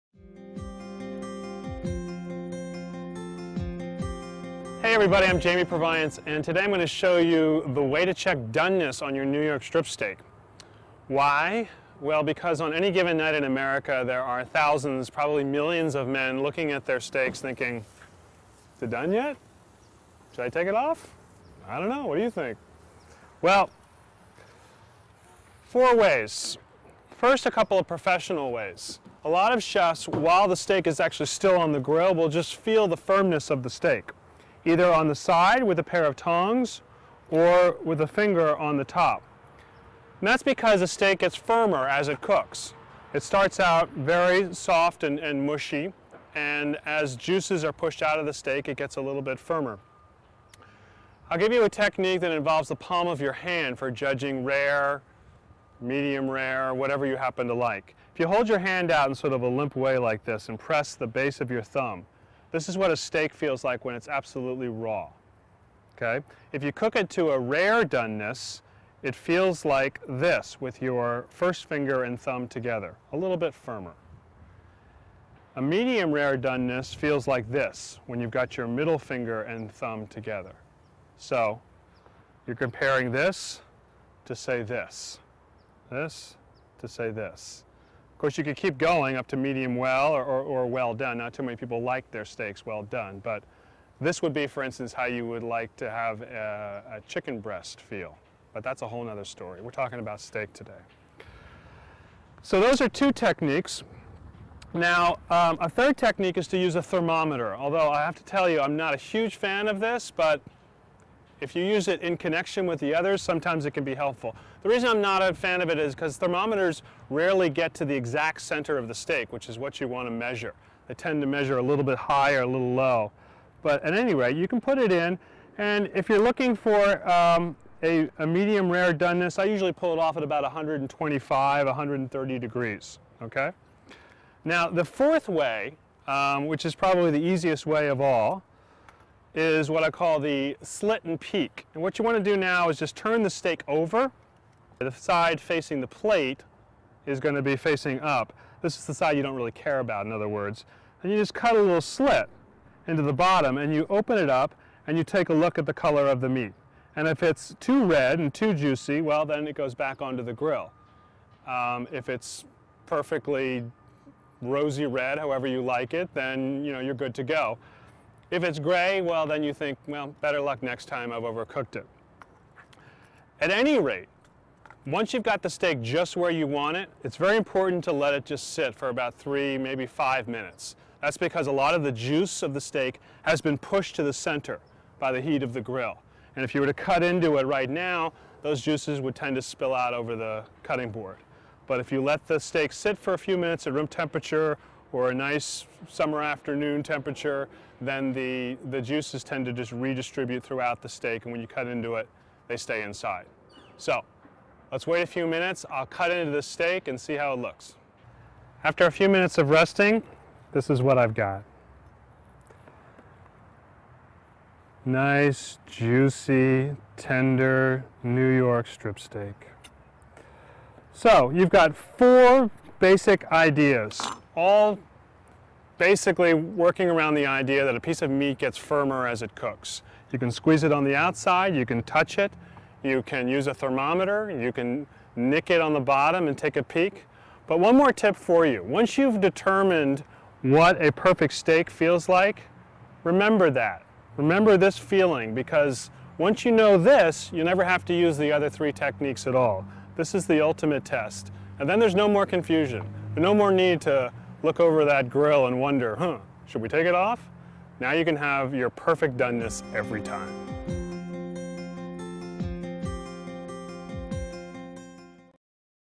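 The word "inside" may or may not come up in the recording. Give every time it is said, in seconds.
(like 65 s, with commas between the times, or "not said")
202 s.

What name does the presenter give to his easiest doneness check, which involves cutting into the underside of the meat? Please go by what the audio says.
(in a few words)
slit and peek.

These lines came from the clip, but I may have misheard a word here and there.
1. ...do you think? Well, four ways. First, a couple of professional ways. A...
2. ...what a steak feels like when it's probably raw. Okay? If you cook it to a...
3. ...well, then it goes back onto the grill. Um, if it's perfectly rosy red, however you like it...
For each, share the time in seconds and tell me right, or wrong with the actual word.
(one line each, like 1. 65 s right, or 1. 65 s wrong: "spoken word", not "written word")
1. 22 s right
2. 62 s wrong: "absolutely", not "probably"
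3. 159 s right.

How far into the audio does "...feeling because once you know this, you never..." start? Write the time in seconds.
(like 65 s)
244 s.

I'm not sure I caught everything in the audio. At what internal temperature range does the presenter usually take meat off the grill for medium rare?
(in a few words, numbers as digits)
125-130 degrees.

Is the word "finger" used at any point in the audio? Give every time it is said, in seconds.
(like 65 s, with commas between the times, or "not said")
38 s, 71 s, 78 s.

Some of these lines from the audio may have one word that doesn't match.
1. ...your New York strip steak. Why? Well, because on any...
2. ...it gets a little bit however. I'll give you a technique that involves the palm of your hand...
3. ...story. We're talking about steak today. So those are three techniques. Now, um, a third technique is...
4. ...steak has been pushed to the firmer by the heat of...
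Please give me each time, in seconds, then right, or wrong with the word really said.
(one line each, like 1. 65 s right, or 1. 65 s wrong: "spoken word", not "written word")
1. 9 s right
2. 48 s wrong: "firmer", not "however"
3. 99 s wrong: "two", not "three"
4. 182 s wrong: "center", not "firmer".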